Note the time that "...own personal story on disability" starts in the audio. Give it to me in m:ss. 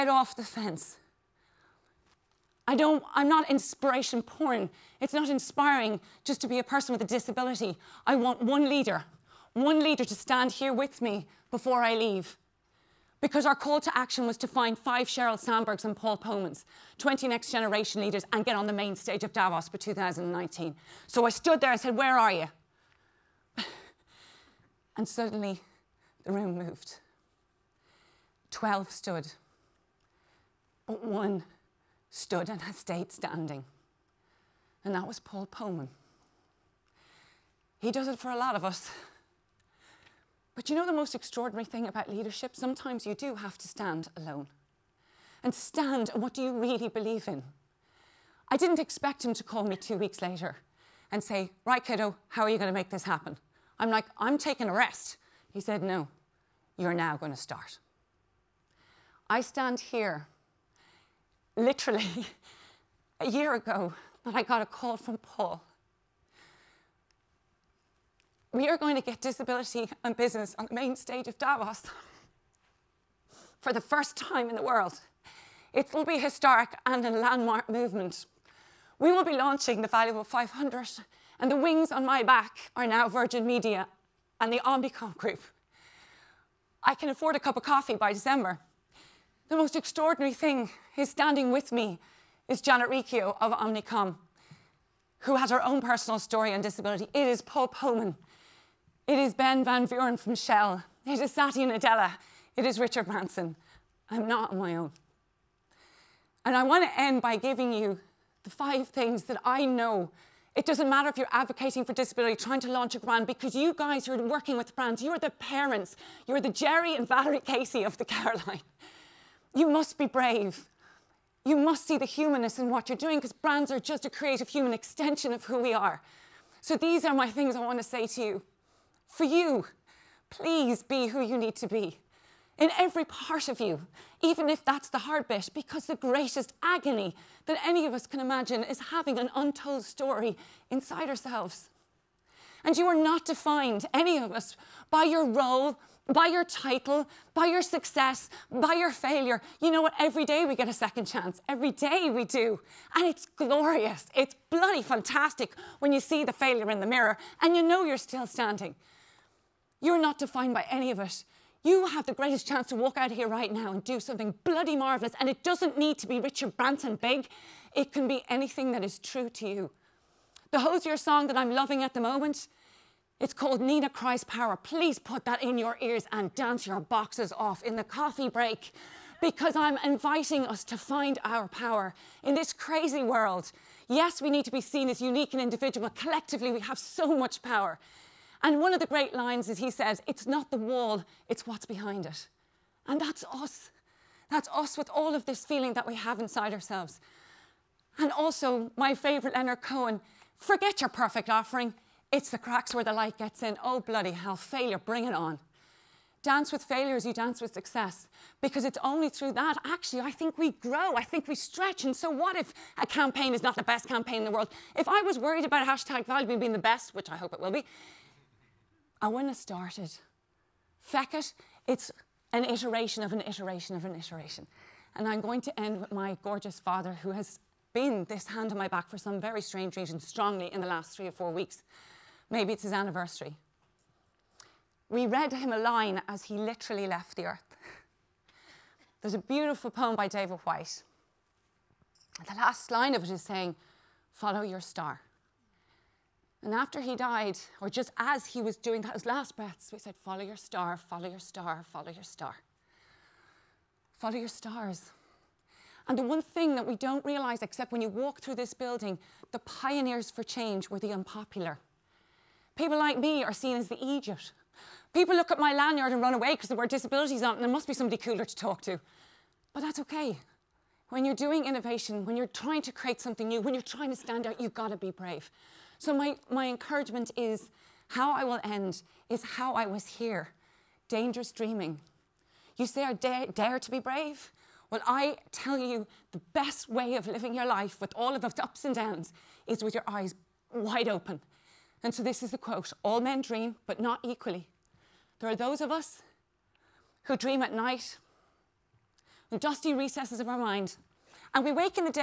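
1:35.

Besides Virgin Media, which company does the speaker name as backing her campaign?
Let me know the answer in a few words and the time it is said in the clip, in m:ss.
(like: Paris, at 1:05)
Omnicom Group, at 1:24.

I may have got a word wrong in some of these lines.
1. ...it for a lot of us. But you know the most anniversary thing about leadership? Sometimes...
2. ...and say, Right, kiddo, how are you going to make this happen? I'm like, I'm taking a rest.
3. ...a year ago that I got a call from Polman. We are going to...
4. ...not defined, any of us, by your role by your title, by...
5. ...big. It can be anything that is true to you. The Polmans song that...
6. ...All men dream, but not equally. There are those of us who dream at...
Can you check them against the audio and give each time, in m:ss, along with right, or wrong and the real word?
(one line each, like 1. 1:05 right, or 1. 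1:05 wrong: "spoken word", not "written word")
1. 0:38 wrong: "extraordinary", not "anniversary"
2. 0:51 right
3. 1:03 wrong: "Paul", not "Polman"
4. 2:22 right
5. 2:46 wrong: "Hozier", not "Polmans"
6. 4:52 right.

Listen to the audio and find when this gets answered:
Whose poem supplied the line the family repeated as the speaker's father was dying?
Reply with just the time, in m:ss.
4:00.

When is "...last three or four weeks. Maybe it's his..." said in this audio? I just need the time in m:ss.
3:50.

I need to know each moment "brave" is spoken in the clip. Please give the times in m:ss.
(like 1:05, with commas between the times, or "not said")
2:00, 4:34, 4:43.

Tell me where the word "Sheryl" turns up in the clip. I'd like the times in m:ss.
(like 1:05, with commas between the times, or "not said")
0:15.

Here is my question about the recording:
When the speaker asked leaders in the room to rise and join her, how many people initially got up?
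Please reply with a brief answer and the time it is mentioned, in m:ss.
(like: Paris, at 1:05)
12, at 0:28.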